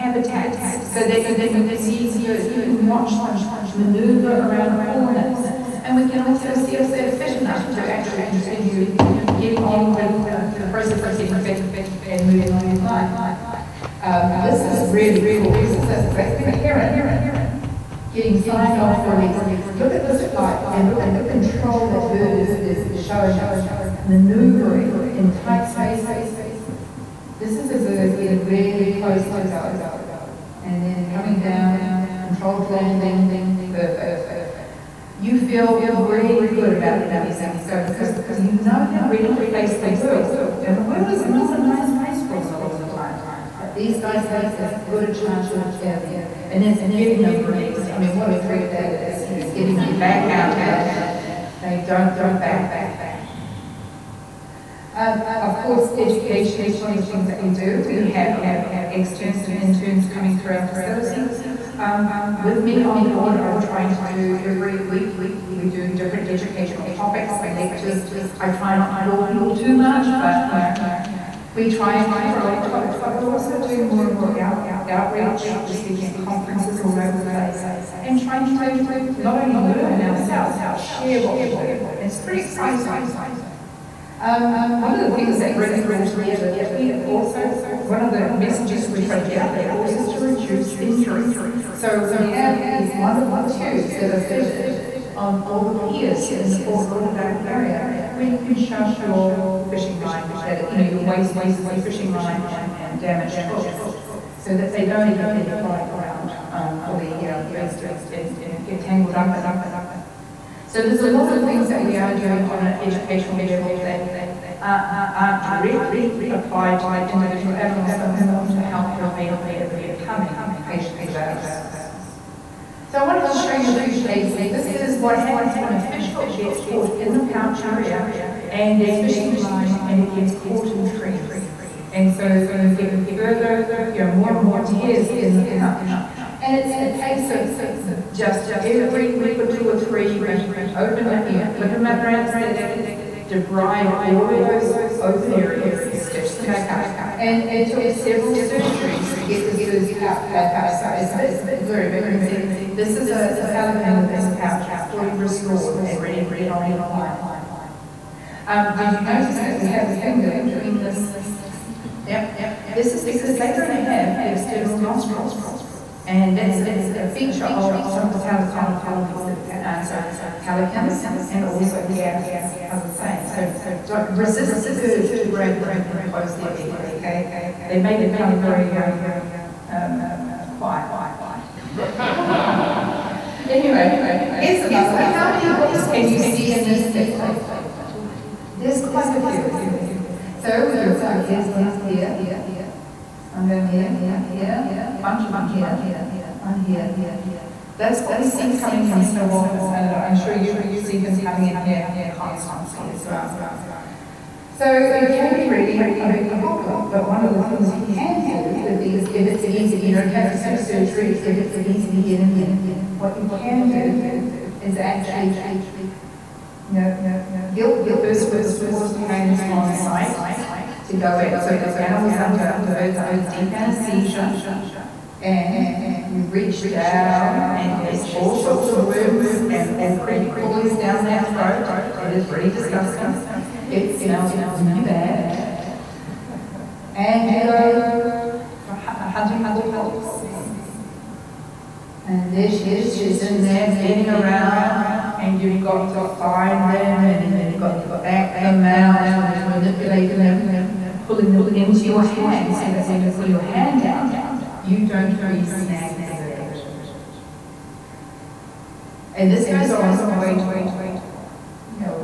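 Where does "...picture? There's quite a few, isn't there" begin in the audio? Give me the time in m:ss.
3:06.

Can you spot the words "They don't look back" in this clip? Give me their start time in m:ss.
0:51.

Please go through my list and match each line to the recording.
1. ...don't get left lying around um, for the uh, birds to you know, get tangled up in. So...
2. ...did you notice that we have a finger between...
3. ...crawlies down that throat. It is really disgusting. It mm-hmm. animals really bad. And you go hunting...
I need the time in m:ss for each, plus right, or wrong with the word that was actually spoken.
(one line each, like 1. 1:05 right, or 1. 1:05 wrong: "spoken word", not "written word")
1. 1:44 right
2. 2:38 right
3. 3:50 wrong: "smells", not "animals".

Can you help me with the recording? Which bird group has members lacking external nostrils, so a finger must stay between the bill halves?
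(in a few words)
Pelecaniformes.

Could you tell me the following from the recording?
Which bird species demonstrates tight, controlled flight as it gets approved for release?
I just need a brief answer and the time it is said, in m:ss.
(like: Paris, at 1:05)
Great red heron, at 0:16.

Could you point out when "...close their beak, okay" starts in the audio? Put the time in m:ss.
2:56.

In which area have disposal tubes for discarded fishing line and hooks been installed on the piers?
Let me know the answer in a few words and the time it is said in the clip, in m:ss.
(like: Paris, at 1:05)
Fort Lauderdale, at 1:36.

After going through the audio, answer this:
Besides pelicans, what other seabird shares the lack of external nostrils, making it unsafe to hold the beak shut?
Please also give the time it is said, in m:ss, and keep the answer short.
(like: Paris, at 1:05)
Gannets, at 2:51.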